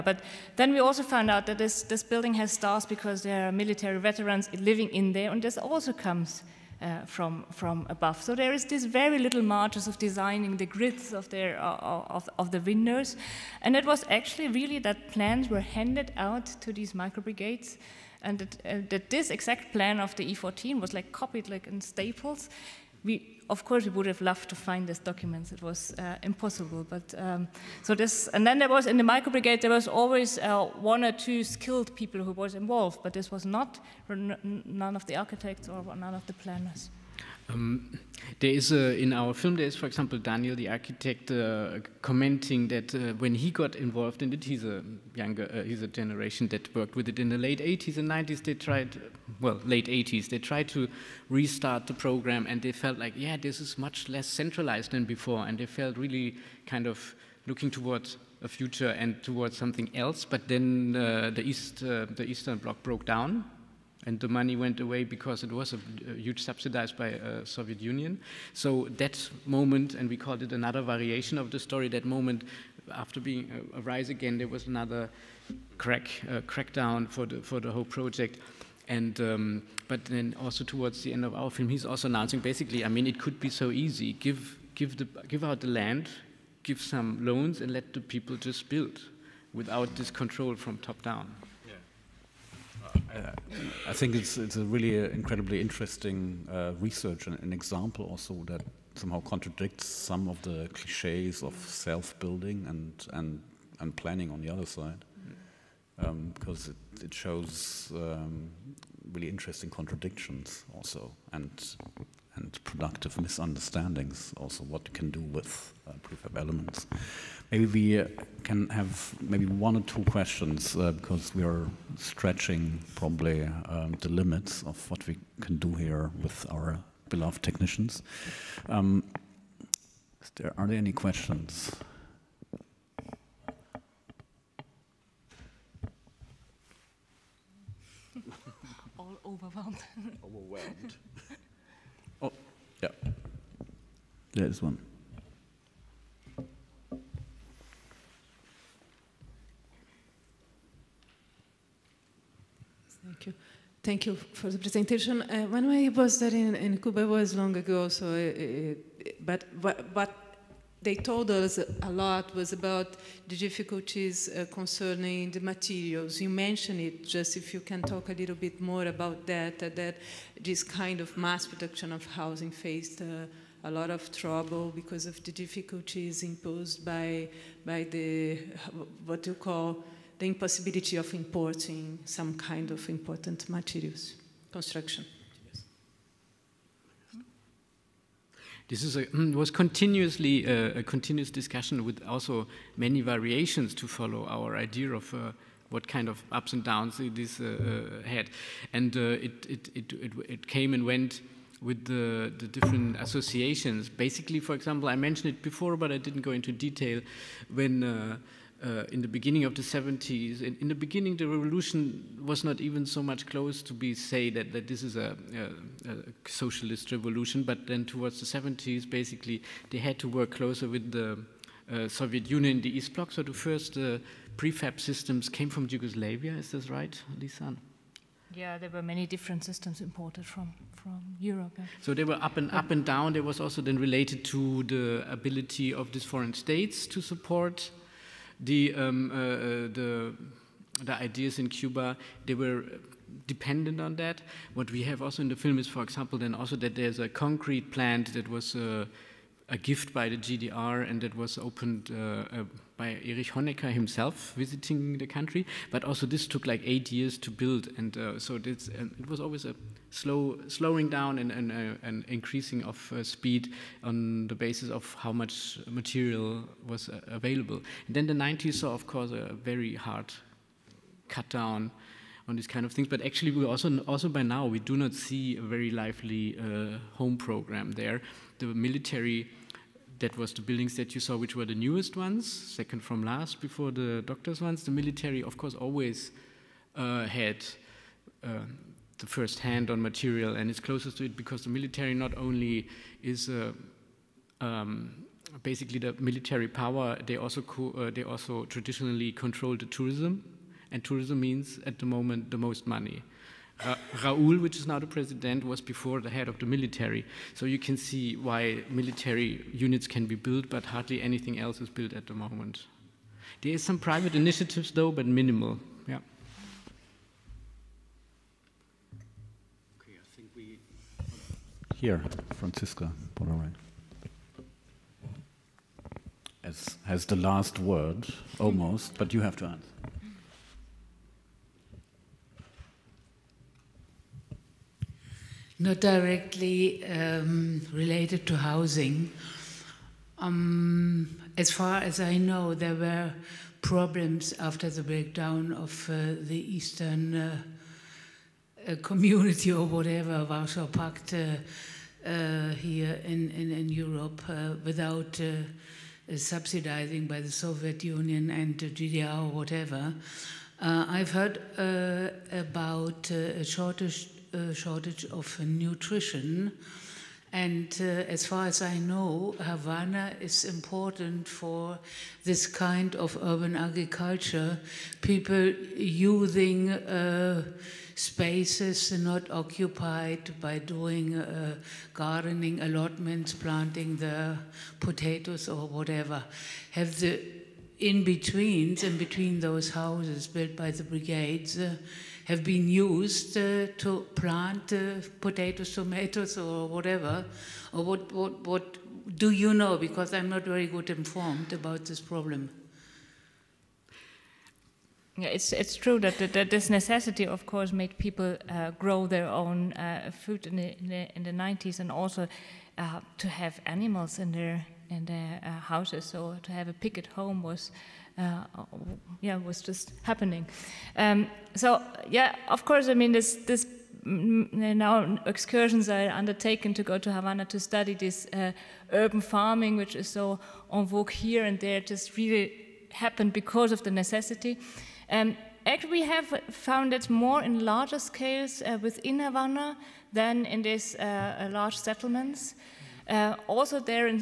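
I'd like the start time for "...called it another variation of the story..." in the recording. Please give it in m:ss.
1:10.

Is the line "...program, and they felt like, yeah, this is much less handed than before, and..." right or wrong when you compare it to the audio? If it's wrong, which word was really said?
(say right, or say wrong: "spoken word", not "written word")
wrong: "centralized", not "handed".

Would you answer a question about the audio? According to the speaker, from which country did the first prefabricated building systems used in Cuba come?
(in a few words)
Yugoslavia.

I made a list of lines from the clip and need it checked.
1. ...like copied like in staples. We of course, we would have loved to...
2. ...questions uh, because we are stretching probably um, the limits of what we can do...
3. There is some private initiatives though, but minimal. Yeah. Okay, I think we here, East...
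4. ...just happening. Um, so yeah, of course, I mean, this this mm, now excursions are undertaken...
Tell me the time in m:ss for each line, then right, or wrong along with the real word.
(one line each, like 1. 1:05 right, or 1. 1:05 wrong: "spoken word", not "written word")
1. 0:20 right
2. 2:00 right
3. 5:13 wrong: "Francisca", not "East"
4. 6:59 right.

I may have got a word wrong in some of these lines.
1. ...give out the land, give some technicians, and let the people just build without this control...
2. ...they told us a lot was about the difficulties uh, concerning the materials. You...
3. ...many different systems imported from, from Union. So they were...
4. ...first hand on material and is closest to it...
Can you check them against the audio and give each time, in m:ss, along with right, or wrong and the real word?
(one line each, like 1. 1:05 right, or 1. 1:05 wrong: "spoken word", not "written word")
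1. 1:25 wrong: "loans", not "technicians"
2. 2:40 right
3. 3:48 wrong: "Europe", not "Union"
4. 4:49 right.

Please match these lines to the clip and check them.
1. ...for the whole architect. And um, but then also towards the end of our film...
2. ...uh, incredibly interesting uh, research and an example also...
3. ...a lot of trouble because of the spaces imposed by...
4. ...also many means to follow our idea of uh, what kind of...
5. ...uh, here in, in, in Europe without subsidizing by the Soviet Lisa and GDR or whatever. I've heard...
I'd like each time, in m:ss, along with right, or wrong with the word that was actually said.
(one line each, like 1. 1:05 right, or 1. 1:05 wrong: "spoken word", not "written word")
1. 1:17 wrong: "project", not "architect"
2. 1:34 right
3. 2:53 wrong: "difficulties", not "spaces"
4. 3:12 wrong: "variations", not "means"
5. 5:52 wrong: "Union", not "Lisa".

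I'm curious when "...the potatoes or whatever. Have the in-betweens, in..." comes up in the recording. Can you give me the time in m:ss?
6:23.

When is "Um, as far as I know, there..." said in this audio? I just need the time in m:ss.
5:40.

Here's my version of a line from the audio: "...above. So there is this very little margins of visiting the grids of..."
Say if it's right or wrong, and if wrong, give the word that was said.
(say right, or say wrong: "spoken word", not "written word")
wrong: "designing", not "visiting".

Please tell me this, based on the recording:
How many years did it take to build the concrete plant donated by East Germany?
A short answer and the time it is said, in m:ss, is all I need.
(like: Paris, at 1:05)
8, at 4:16.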